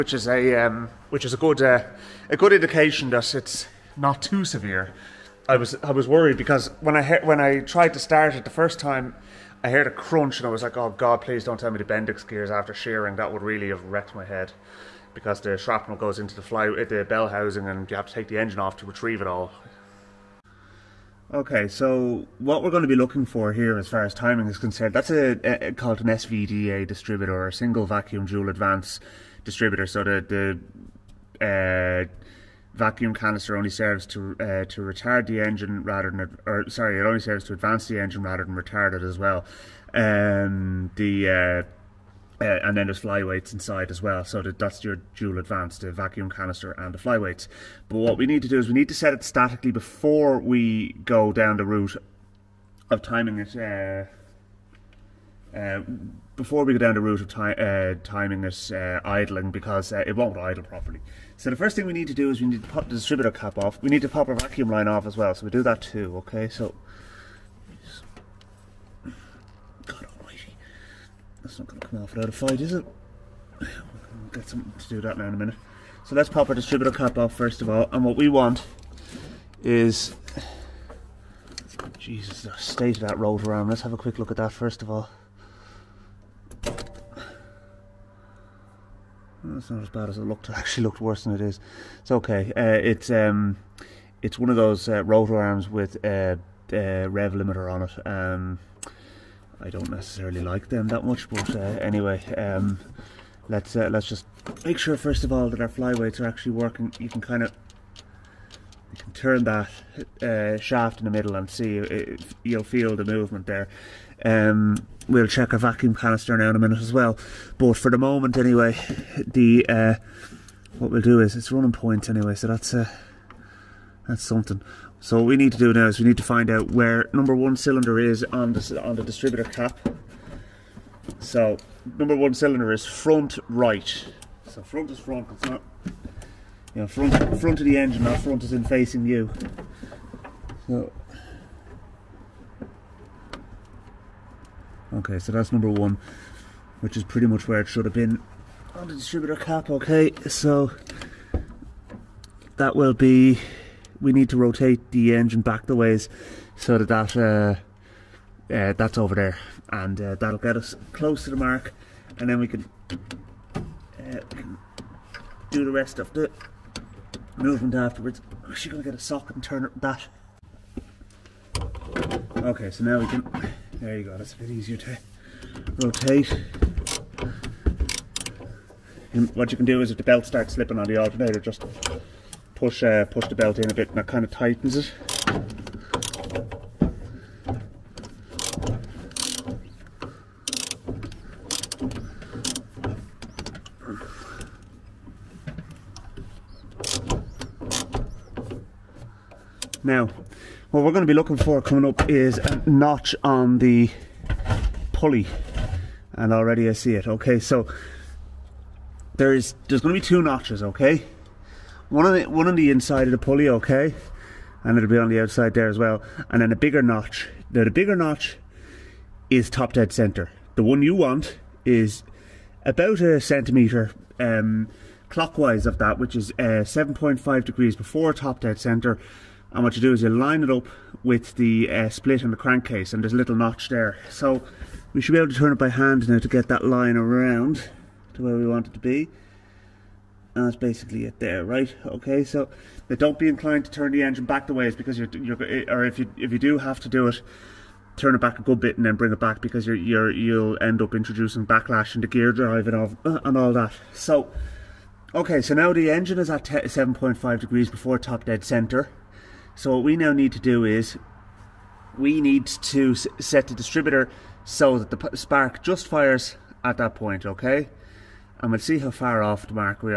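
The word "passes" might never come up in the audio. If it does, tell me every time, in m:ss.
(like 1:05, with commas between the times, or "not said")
not said.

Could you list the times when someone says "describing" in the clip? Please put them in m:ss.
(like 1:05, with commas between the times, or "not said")
not said.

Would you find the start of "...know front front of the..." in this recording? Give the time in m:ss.
2:16.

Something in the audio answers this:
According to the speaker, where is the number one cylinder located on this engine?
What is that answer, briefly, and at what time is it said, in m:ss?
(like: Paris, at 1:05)
Front right, at 2:12.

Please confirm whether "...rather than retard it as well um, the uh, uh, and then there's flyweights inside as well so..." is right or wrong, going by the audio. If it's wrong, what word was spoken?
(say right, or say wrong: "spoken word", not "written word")
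right.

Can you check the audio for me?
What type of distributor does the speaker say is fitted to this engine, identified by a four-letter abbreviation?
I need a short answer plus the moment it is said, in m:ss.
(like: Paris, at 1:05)
SVDA, at 0:26.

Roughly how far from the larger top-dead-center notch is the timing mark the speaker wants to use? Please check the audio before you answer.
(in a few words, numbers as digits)
About a centimeter.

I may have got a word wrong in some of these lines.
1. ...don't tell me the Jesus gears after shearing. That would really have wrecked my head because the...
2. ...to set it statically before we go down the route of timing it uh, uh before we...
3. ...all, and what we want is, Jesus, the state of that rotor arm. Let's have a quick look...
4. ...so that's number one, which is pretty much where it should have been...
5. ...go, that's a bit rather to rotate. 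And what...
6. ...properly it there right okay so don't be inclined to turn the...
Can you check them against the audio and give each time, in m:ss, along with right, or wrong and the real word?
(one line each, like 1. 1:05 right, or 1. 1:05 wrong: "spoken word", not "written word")
1. 0:11 wrong: "Bendix", not "Jesus"
2. 0:48 right
3. 1:17 right
4. 2:25 right
5. 2:54 wrong: "easier", not "rather"
6. 4:00 wrong: "basically", not "properly".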